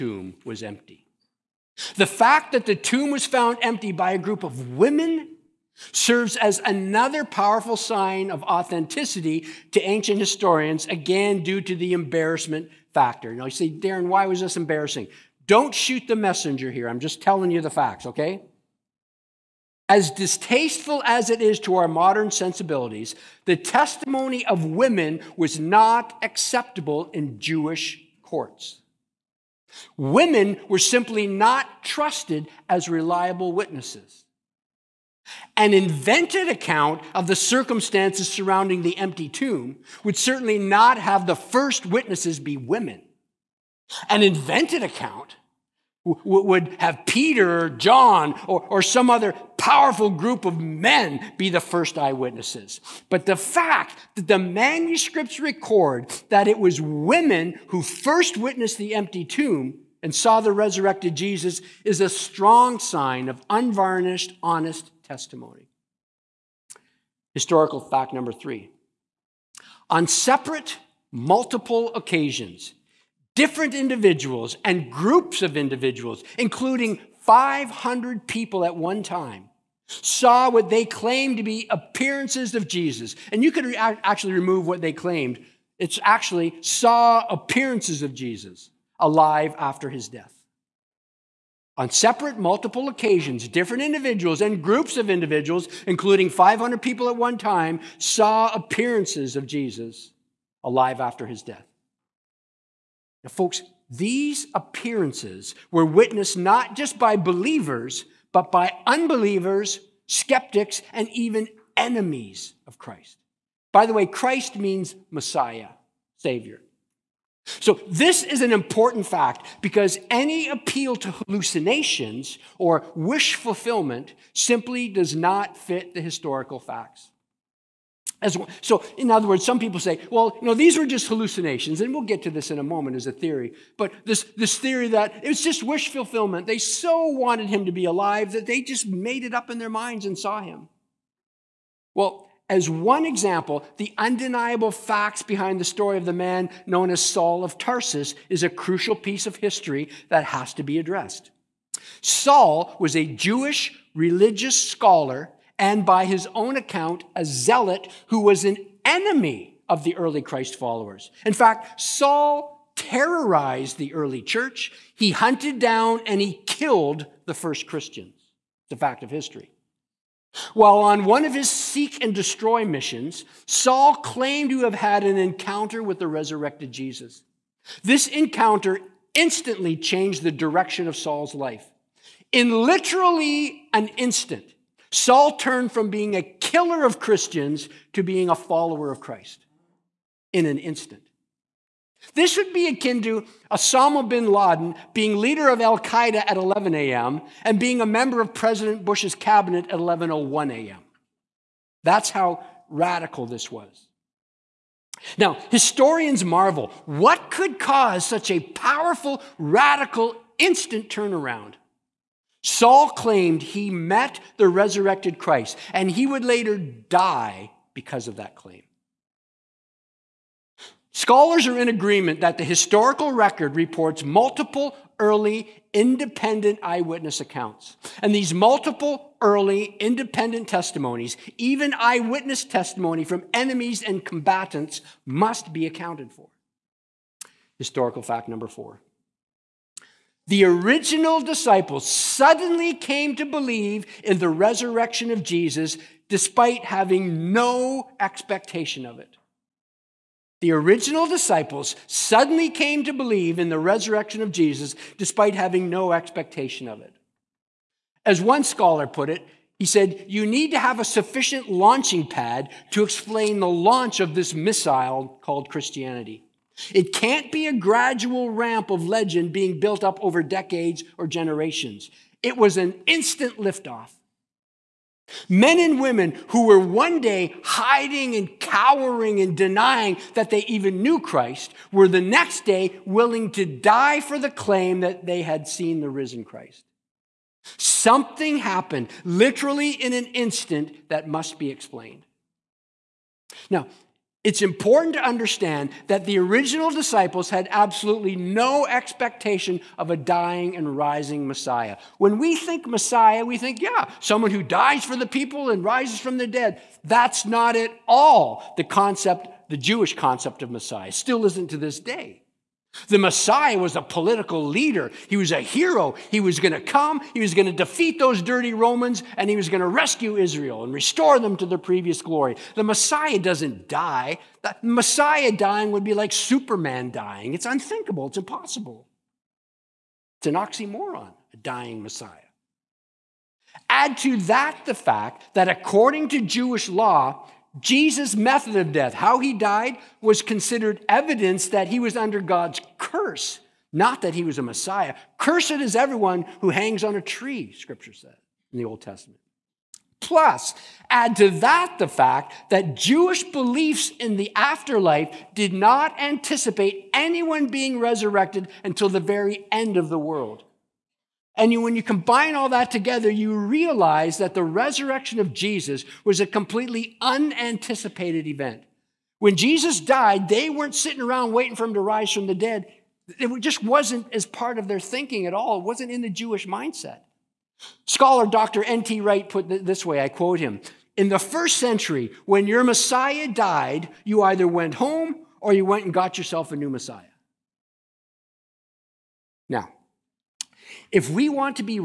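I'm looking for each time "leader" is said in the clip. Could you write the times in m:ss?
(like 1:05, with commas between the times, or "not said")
3:15, 5:14.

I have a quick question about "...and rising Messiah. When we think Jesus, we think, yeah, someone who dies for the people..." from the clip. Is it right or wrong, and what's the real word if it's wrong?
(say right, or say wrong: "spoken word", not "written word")
wrong: "Messiah", not "Jesus".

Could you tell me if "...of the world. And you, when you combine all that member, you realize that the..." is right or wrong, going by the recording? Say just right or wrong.
wrong.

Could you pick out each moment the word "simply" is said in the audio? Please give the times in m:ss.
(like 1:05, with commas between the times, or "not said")
0:30, 2:04.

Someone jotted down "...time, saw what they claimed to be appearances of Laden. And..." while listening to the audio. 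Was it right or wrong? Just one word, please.
wrong.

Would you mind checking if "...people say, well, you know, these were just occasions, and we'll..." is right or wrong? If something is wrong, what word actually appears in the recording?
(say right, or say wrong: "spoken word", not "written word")
wrong: "hallucinations", not "occasions".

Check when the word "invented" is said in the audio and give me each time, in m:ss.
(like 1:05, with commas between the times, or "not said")
0:35, 0:44.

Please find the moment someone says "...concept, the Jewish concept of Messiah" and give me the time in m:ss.
5:08.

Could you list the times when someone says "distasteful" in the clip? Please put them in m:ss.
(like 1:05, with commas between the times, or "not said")
0:20.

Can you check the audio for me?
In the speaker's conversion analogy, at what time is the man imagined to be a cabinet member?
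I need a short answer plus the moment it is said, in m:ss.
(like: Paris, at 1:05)
11:01 a.m., at 3:19.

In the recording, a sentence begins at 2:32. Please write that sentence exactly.
Saul was a Jewish religious scholar and by his own account, a zealot who was an enemy of the early Christ followers.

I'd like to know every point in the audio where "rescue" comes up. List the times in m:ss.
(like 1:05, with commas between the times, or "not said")
5:19.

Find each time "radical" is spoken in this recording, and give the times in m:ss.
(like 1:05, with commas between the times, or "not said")
3:22, 3:29.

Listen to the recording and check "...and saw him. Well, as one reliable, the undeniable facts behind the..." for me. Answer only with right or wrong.
wrong.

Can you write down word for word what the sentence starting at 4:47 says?
Something happened, literally in an instant, that must be explained.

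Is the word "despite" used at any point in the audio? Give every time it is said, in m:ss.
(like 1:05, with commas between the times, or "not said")
4:06, 4:14.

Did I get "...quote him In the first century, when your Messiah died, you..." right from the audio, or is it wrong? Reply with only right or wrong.
right.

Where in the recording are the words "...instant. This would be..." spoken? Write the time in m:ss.
3:10.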